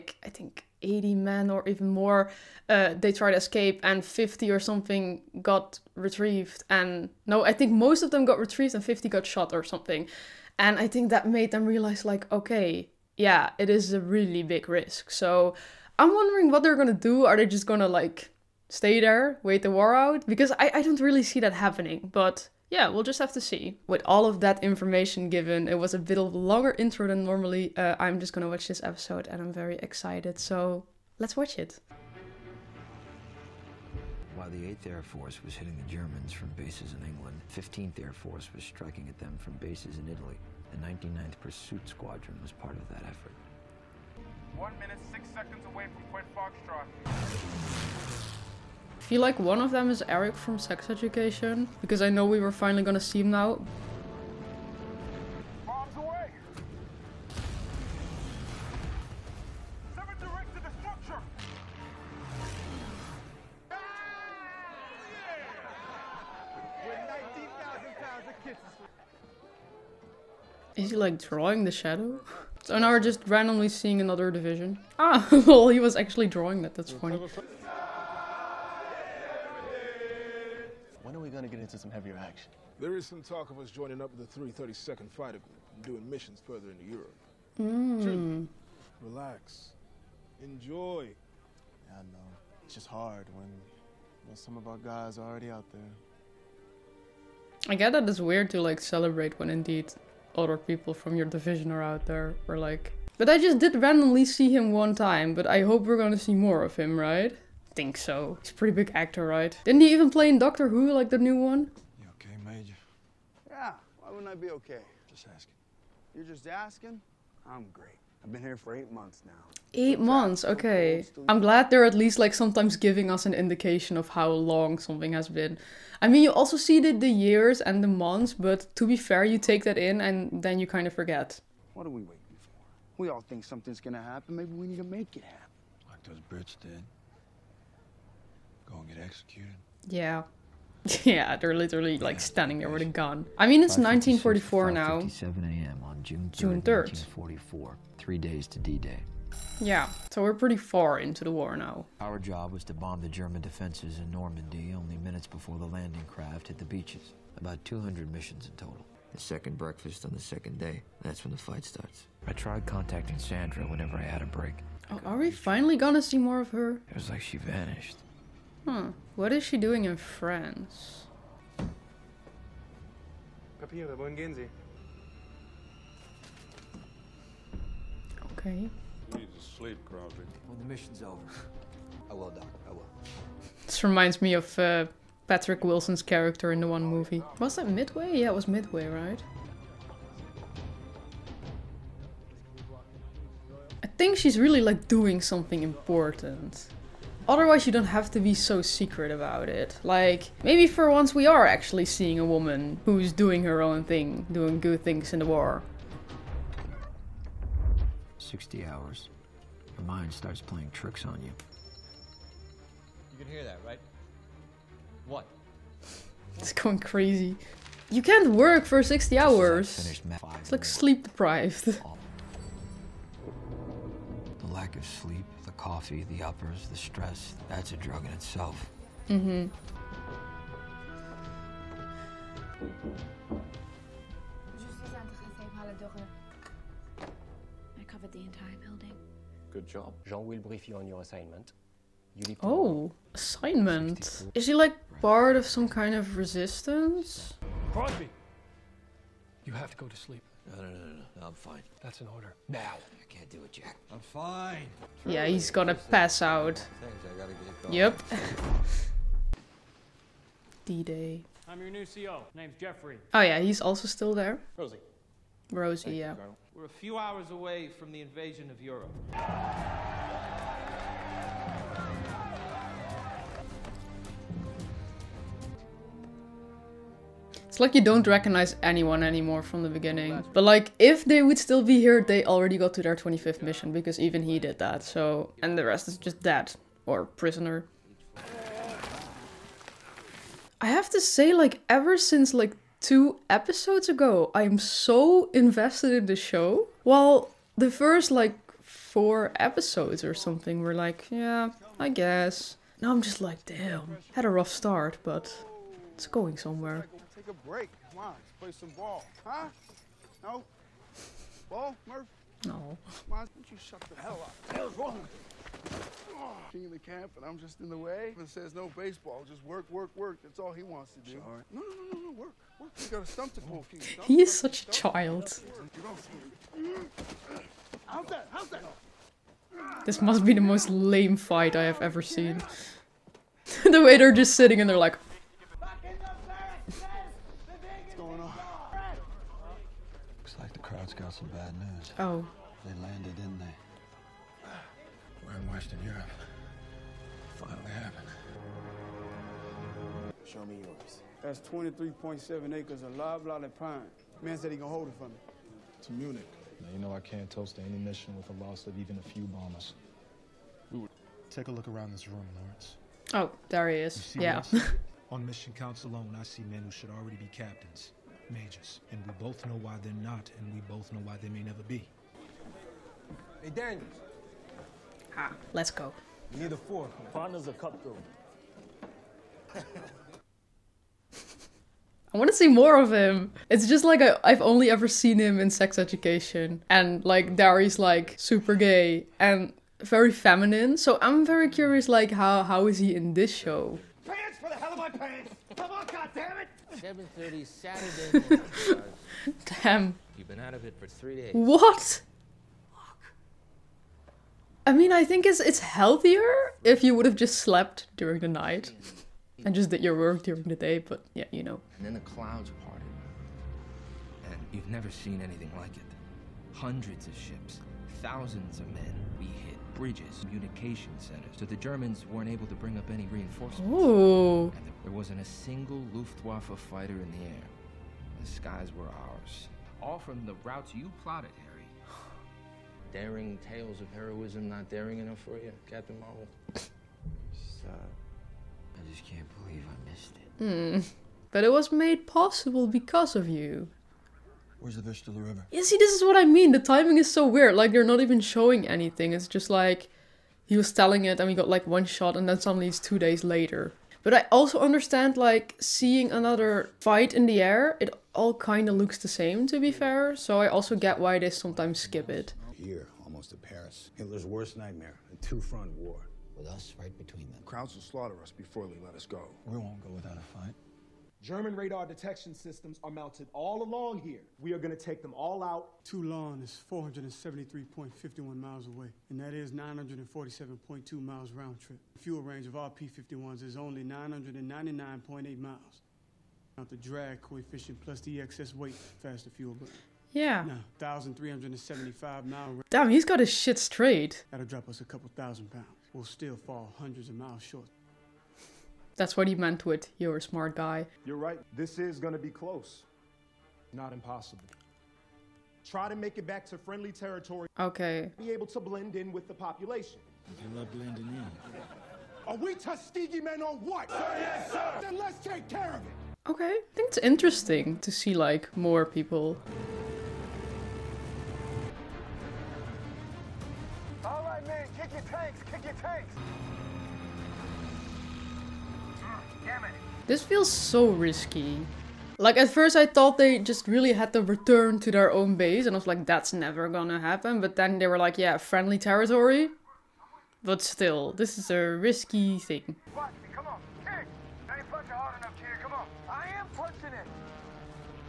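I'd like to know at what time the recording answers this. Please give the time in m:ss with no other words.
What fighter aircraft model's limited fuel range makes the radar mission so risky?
8:02.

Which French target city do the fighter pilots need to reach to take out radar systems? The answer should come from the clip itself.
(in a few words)
Toulon.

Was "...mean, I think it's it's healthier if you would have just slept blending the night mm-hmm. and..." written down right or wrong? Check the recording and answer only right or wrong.
wrong.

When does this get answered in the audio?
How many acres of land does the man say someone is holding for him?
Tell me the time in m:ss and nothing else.
5:51.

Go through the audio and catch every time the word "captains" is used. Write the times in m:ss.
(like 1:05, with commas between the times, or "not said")
6:07, 7:15.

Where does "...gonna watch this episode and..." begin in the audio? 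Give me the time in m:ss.
0:28.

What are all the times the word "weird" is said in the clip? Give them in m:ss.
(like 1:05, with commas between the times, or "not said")
1:38, 7:27.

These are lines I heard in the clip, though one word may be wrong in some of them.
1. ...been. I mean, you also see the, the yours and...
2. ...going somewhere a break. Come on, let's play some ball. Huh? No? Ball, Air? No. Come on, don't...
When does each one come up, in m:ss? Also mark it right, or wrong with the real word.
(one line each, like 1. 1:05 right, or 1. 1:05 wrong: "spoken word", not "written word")
1. 2:05 wrong: "years", not "yours"
2. 5:06 wrong: "Murph", not "Air".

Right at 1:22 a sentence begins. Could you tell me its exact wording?
There is some talk of us joining up with the 332nd Fighter Group and doing missions further into Europe.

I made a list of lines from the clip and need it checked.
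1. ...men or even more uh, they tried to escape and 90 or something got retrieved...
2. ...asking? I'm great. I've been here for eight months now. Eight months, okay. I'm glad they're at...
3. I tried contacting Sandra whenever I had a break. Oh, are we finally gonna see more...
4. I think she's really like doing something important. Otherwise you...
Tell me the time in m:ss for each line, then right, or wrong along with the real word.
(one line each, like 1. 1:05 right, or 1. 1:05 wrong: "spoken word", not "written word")
1. 0:01 wrong: "50", not "90"
2. 1:56 right
3. 2:42 right
4. 3:13 right.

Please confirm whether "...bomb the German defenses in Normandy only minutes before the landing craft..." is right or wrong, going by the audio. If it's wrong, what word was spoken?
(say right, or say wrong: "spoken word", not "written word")
right.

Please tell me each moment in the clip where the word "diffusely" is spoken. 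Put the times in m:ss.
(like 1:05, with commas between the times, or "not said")
not said.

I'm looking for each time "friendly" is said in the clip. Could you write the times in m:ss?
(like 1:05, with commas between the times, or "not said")
8:26, 8:58.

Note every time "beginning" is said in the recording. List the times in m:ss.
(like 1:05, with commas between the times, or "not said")
4:39.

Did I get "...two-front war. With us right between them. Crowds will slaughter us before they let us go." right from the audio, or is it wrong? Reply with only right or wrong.
right.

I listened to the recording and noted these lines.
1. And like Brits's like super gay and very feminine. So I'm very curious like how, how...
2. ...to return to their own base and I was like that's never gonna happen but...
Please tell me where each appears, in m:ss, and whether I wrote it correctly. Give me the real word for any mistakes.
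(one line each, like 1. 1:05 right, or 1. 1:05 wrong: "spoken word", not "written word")
1. 6:26 wrong: "Dari", not "Brits"
2. 8:54 right.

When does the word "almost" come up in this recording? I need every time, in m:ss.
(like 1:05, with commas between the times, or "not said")
7:43.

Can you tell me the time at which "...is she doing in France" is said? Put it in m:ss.
2:49.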